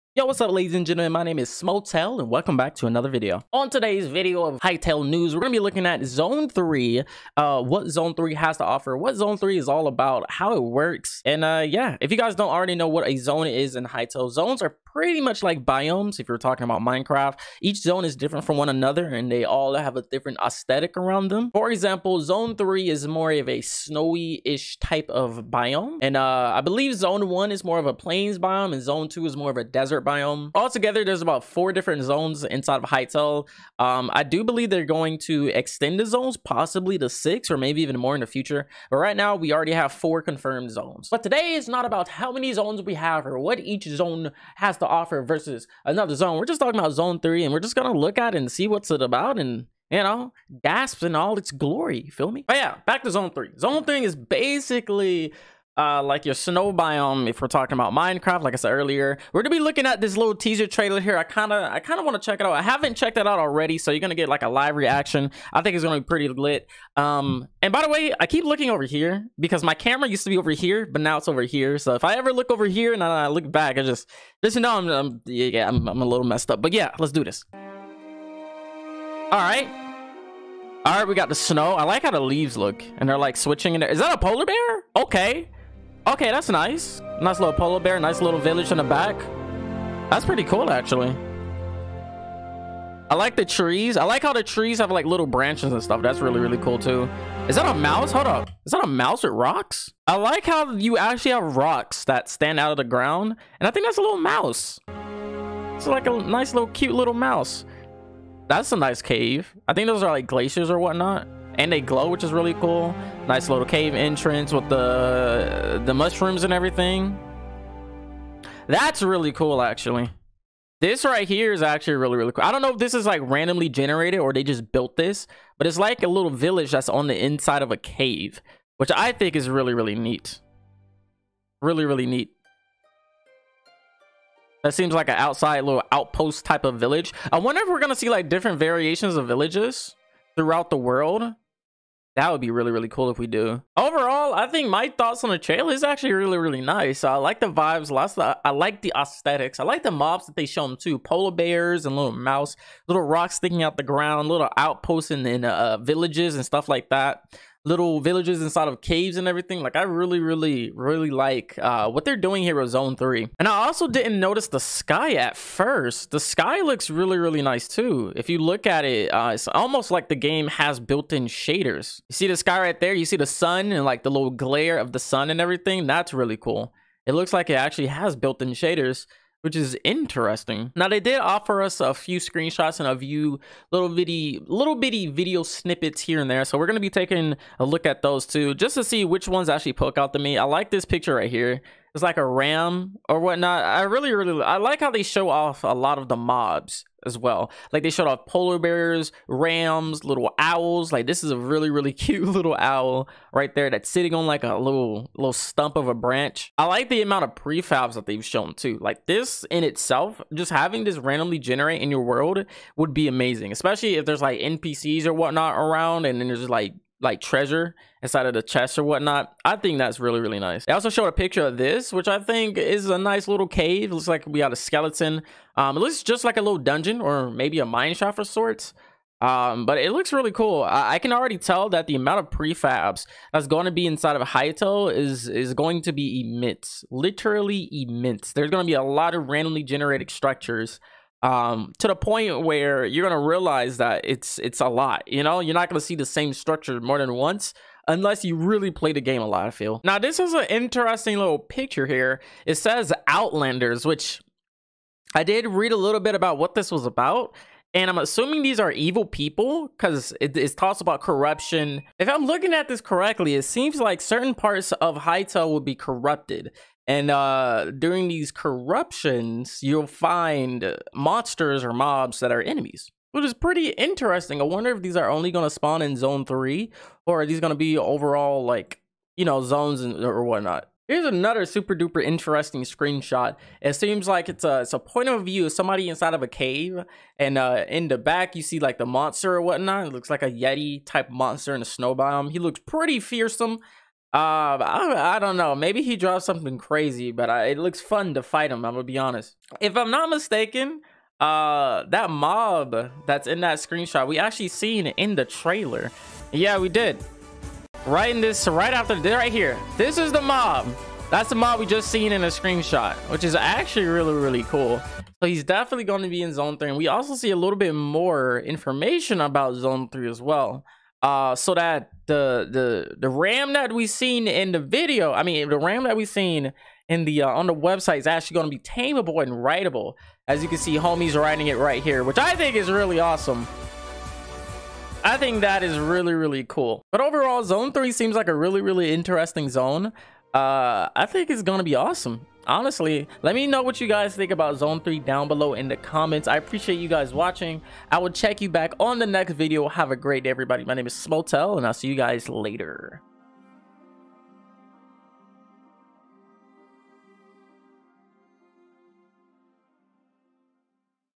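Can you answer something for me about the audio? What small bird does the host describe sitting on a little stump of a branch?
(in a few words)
Owl.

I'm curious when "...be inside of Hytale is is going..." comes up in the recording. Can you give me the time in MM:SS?
03:53.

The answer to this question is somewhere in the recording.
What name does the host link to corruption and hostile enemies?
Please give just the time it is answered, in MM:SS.
04:13.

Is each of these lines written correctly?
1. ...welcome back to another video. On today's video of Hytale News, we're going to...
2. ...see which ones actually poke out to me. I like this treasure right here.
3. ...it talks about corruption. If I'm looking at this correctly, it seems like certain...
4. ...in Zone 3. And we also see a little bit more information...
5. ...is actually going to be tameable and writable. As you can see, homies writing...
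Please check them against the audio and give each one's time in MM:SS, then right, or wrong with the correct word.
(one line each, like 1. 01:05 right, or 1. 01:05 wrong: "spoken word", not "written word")
1. 00:02 right
2. 03:08 wrong: "picture", not "treasure"
3. 04:20 right
4. 05:16 right
5. 05:27 right.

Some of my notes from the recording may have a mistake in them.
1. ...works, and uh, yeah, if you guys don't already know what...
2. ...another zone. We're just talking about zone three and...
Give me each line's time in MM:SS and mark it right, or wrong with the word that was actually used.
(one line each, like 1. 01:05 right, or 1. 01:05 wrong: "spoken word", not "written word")
1. 00:10 right
2. 00:45 right.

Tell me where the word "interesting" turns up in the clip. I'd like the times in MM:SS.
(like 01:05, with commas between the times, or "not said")
02:59, 04:10, 04:33, 04:42, 05:38.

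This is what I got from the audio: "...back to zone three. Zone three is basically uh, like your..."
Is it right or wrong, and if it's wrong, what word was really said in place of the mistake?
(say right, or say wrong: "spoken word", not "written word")
right.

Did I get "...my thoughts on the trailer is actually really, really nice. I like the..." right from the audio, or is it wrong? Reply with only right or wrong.
right.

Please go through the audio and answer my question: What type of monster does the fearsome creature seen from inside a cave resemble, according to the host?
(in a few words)
Yeti.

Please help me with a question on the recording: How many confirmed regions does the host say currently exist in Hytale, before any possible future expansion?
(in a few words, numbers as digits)
4.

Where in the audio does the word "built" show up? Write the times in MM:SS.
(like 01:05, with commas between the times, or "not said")
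02:04, 02:50, 02:58.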